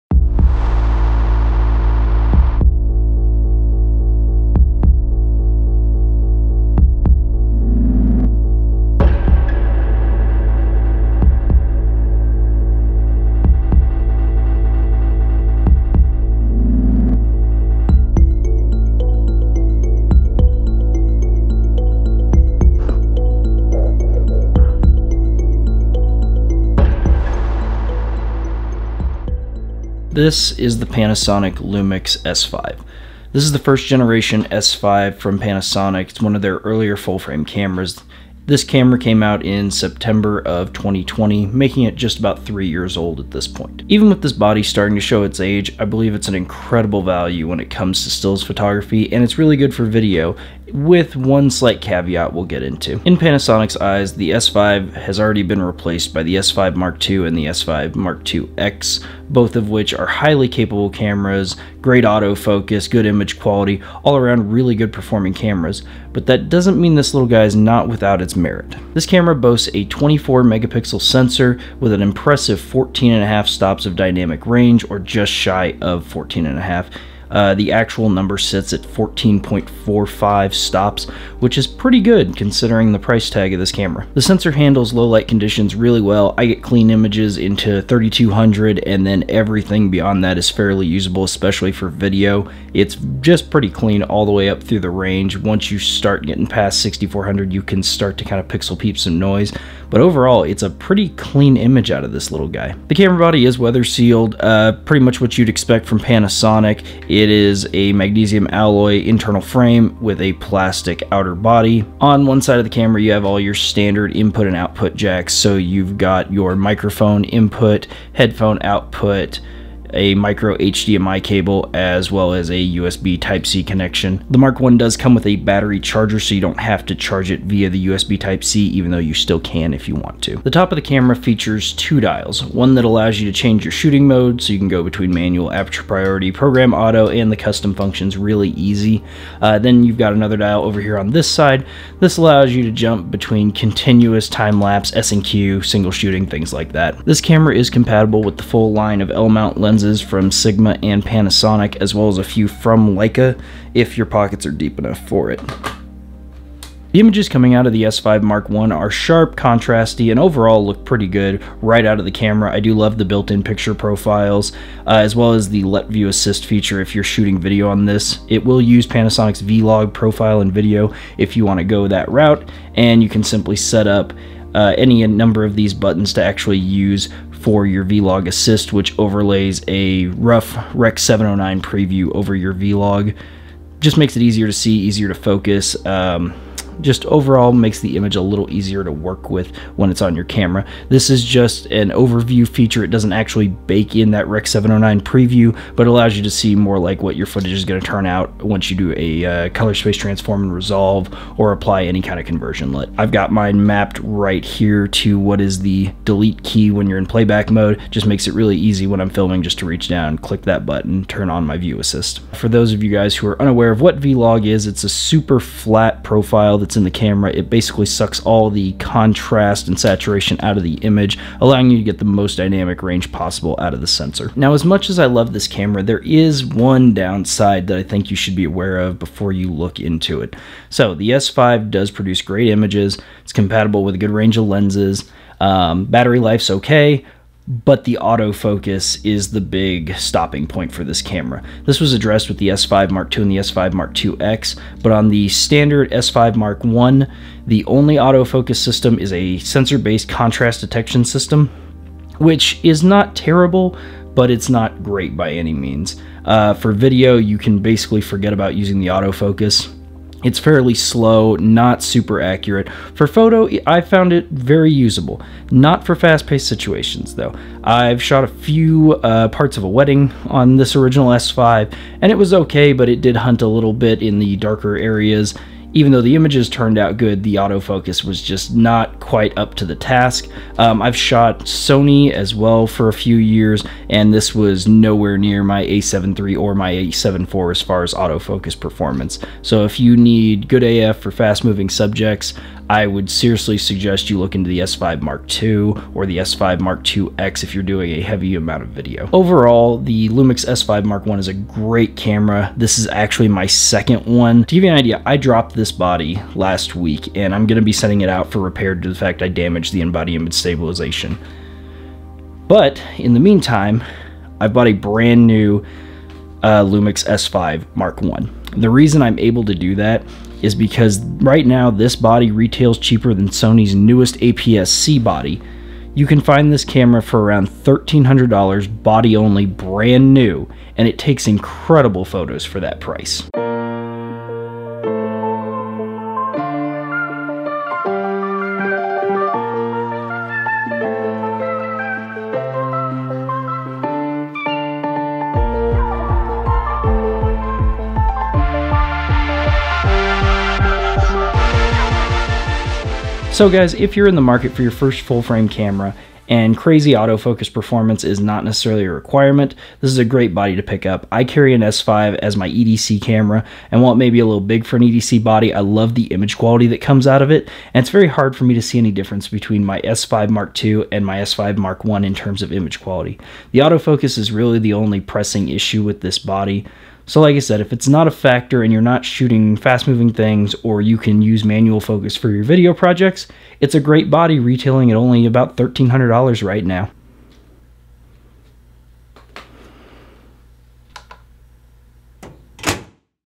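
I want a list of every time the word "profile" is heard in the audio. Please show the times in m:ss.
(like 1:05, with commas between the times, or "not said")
2:43, 2:49, 3:36.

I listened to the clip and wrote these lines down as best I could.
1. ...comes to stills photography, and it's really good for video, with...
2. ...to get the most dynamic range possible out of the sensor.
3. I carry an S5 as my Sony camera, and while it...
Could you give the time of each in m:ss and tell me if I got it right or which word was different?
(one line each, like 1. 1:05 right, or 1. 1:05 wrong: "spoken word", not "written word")
1. 0:47 right
2. 3:41 right
3. 6:01 wrong: "EDC", not "Sony".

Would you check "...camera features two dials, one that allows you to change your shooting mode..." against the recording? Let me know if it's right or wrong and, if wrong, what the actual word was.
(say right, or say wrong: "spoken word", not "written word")
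right.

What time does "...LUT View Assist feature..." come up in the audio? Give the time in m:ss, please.
2:45.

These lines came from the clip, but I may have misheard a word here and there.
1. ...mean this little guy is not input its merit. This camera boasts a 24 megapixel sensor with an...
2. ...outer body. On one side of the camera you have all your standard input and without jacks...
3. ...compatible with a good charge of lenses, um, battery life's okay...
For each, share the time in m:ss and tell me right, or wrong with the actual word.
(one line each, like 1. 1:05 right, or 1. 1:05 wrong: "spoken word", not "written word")
1. 1:06 wrong: "without", not "input"
2. 1:51 wrong: "output", not "without"
3. 3:53 wrong: "range", not "charge".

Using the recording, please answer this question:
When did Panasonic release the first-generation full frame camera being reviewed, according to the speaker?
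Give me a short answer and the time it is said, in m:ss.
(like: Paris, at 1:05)
September 2020, at 0:39.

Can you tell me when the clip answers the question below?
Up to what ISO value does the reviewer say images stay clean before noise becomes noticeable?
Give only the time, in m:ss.
1:27.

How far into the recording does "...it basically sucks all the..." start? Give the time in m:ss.
3:37.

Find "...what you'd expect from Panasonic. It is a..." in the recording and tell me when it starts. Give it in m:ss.
1:45.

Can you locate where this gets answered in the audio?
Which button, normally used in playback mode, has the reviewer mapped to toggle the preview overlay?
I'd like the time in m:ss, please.
3:26.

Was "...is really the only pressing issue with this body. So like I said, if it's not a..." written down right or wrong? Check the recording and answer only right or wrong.
right.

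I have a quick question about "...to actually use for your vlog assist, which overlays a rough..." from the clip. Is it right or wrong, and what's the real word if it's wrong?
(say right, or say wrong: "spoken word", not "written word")
right.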